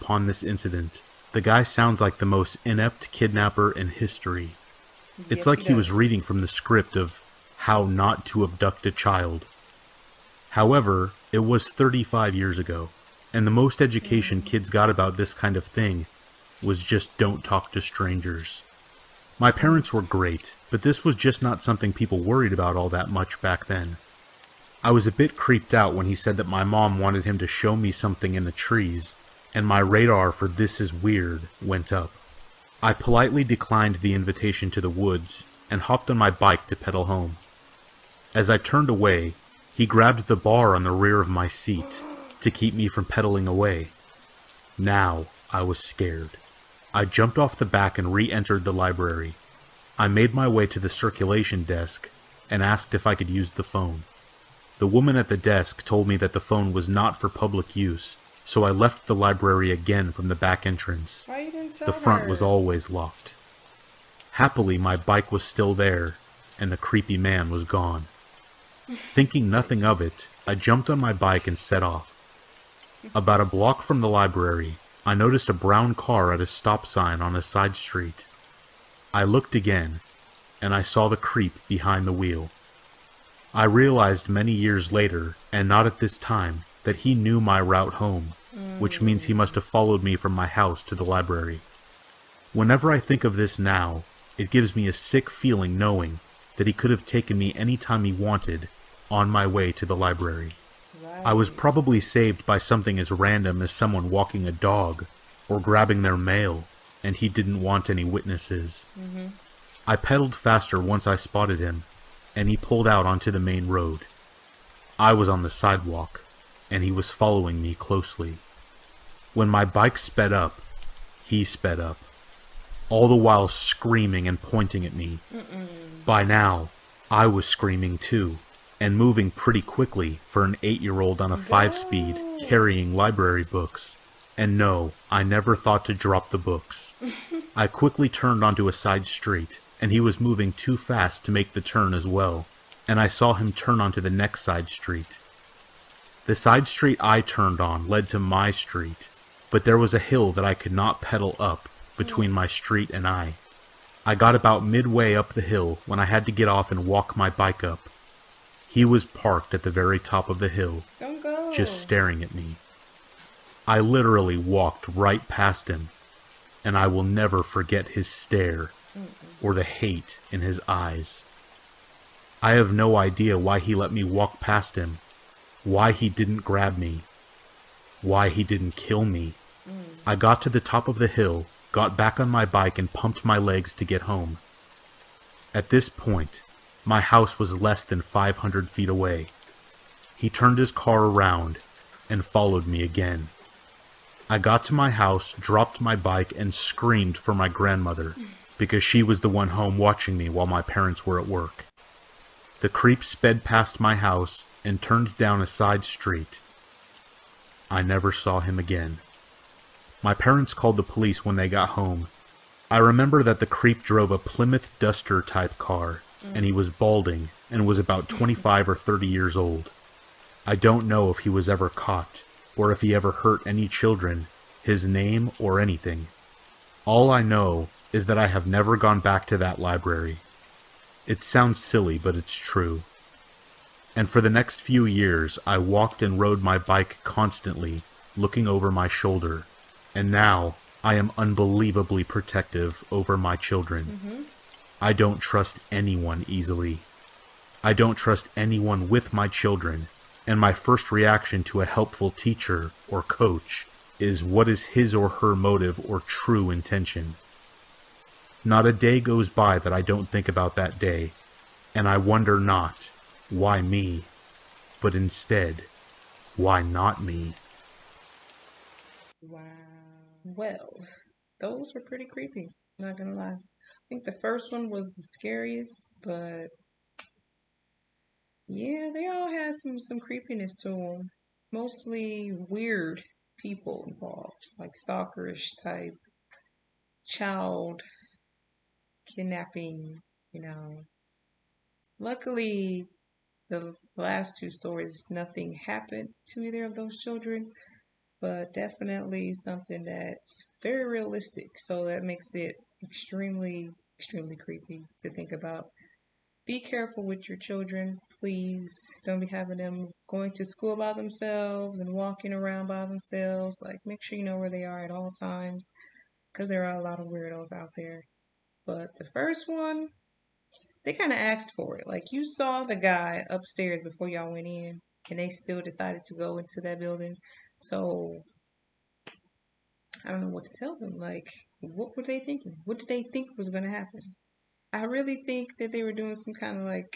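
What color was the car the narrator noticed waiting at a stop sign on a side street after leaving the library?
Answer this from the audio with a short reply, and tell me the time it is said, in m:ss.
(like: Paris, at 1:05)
brown, at 1:15.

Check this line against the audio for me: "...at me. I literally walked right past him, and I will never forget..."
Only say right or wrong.
right.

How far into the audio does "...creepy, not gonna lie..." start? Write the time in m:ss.
4:32.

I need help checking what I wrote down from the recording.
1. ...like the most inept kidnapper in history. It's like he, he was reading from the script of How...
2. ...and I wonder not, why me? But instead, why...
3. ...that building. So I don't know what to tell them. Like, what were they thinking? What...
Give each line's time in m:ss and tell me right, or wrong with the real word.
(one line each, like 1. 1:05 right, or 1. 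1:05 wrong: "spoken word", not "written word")
1. 0:01 right
2. 4:21 right
3. 5:26 right.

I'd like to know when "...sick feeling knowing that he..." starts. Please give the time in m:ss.
1:34.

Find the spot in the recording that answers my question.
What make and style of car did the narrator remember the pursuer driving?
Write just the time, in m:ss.
3:34.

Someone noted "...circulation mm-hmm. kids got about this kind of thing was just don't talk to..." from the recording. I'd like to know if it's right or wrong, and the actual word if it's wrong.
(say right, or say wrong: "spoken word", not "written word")
wrong: "education", not "circulation".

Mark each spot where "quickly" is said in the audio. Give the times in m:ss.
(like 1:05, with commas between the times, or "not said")
2:09, 2:17.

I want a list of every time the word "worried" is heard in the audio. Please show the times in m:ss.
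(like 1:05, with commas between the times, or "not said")
0:22.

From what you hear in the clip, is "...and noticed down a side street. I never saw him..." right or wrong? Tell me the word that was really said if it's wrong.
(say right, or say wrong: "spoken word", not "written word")
wrong: "turned", not "noticed".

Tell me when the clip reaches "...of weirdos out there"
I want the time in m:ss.
5:16.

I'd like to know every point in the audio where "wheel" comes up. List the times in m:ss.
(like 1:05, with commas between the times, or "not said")
1:22.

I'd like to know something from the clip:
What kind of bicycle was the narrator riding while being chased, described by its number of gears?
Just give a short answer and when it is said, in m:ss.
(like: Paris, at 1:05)
five-speed, at 2:11.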